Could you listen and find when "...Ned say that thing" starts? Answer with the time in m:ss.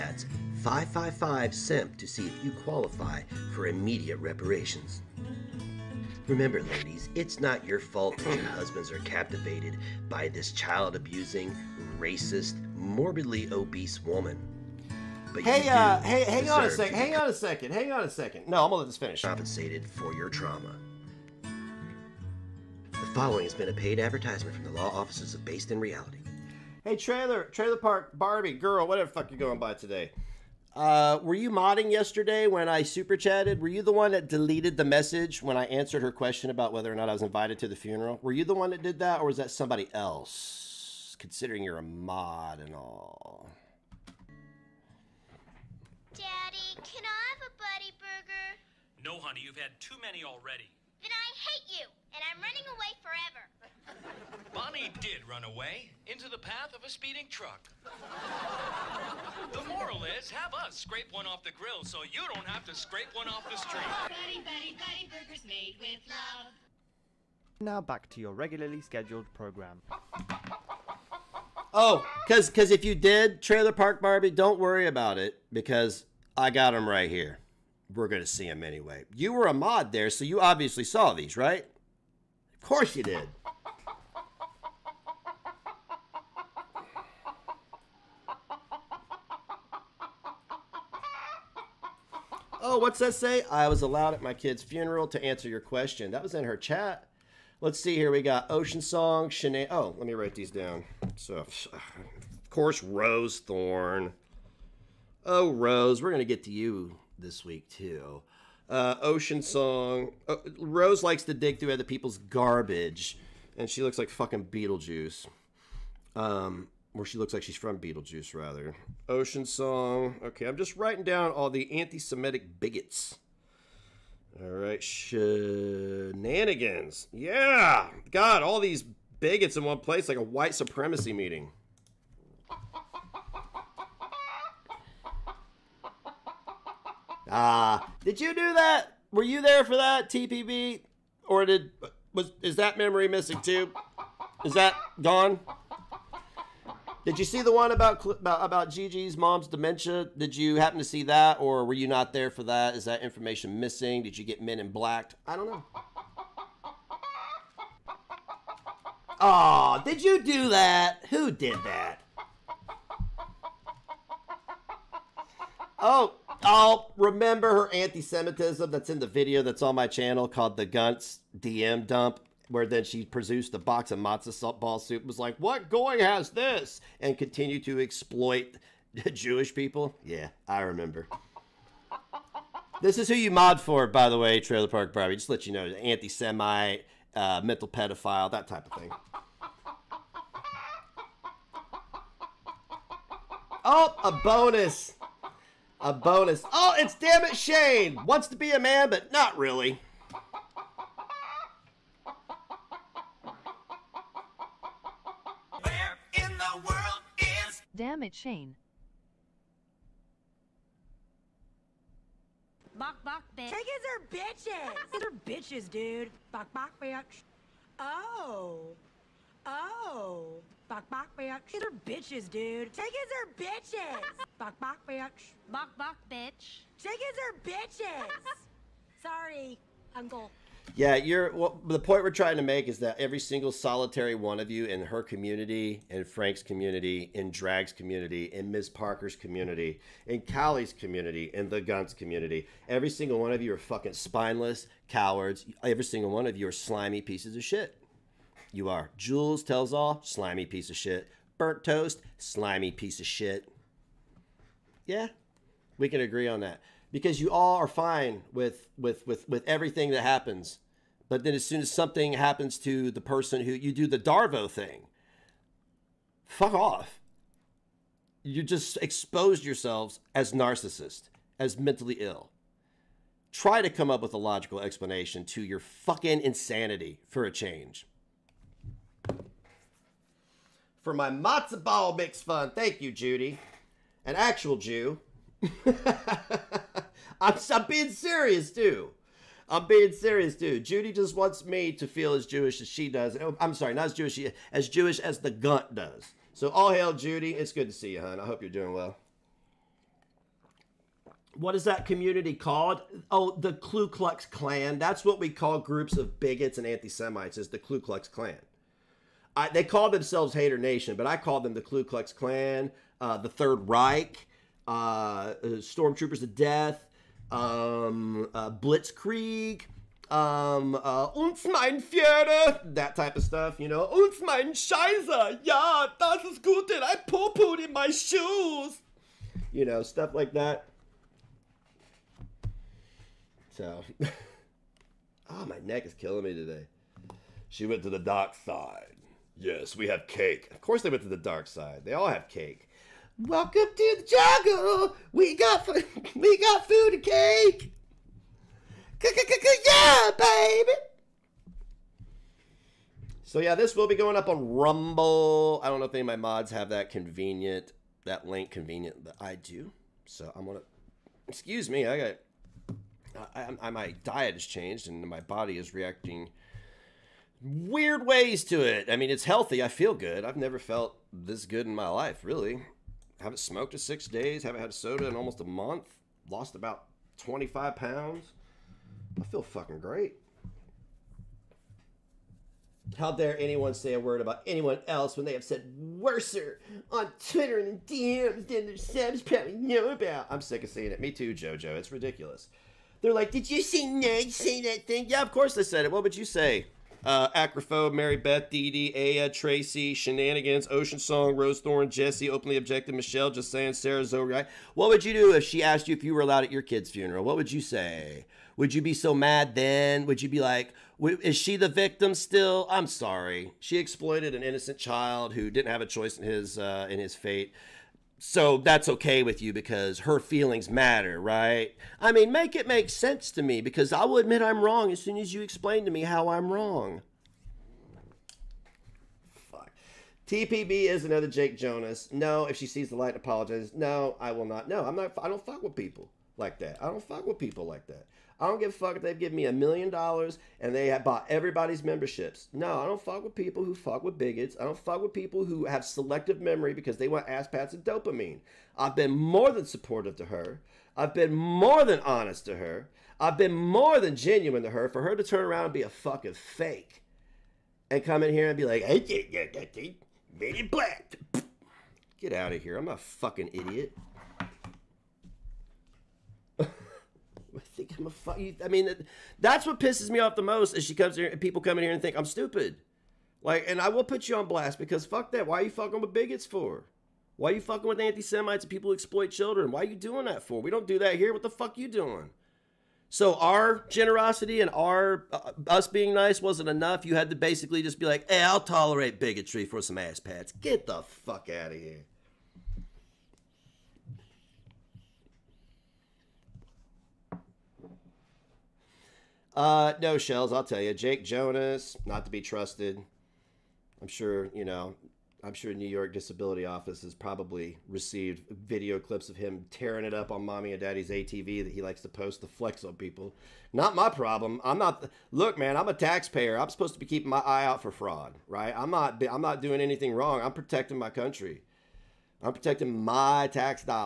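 6:33.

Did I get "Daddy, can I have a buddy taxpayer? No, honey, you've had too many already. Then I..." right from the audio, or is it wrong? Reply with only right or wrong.
wrong.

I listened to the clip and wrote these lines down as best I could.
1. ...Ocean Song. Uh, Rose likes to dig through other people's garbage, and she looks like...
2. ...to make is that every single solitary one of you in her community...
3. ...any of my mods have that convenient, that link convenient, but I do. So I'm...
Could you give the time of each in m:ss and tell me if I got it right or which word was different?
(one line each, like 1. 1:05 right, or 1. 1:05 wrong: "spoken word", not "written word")
1. 1:49 right
2. 3:52 right
3. 5:55 right.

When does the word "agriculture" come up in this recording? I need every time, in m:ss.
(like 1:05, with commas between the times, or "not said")
not said.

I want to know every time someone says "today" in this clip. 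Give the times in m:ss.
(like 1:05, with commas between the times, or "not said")
0:29, 5:36.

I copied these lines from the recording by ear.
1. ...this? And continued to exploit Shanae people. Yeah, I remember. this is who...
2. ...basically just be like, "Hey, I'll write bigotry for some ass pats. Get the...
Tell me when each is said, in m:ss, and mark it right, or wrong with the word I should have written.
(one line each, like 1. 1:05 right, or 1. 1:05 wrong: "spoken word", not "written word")
1. 2:56 wrong: "Jewish", not "Shanae"
2. 8:07 wrong: "tolerate", not "write".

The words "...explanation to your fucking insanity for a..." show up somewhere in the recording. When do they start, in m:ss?
4:34.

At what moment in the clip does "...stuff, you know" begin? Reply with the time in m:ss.
5:23.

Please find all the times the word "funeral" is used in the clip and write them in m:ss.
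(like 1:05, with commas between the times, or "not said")
0:37, 1:34, 6:46.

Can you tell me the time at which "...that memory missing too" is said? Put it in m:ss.
2:22.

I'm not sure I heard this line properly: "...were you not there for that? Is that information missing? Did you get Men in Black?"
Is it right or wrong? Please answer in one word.
right.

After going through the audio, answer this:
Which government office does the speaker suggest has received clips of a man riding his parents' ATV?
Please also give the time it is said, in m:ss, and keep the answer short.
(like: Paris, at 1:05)
New York Disability Office, at 8:25.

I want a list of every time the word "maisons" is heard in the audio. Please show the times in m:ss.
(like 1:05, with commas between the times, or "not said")
not said.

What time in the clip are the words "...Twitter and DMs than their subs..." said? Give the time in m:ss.
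6:27.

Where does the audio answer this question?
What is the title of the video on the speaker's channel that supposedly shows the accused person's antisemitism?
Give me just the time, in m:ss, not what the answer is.
2:50.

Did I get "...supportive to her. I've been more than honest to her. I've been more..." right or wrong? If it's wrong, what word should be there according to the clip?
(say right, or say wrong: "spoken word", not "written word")
right.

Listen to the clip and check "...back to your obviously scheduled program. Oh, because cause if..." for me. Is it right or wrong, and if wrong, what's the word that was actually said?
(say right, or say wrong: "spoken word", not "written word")
wrong: "regularly", not "obviously".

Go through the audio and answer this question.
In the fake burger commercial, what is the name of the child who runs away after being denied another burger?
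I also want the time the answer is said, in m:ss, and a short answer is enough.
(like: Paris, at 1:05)
Bonnie, at 0:54.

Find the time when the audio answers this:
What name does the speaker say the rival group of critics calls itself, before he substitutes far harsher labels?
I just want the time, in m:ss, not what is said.
5:10.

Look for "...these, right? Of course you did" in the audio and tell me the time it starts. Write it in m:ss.
1:21.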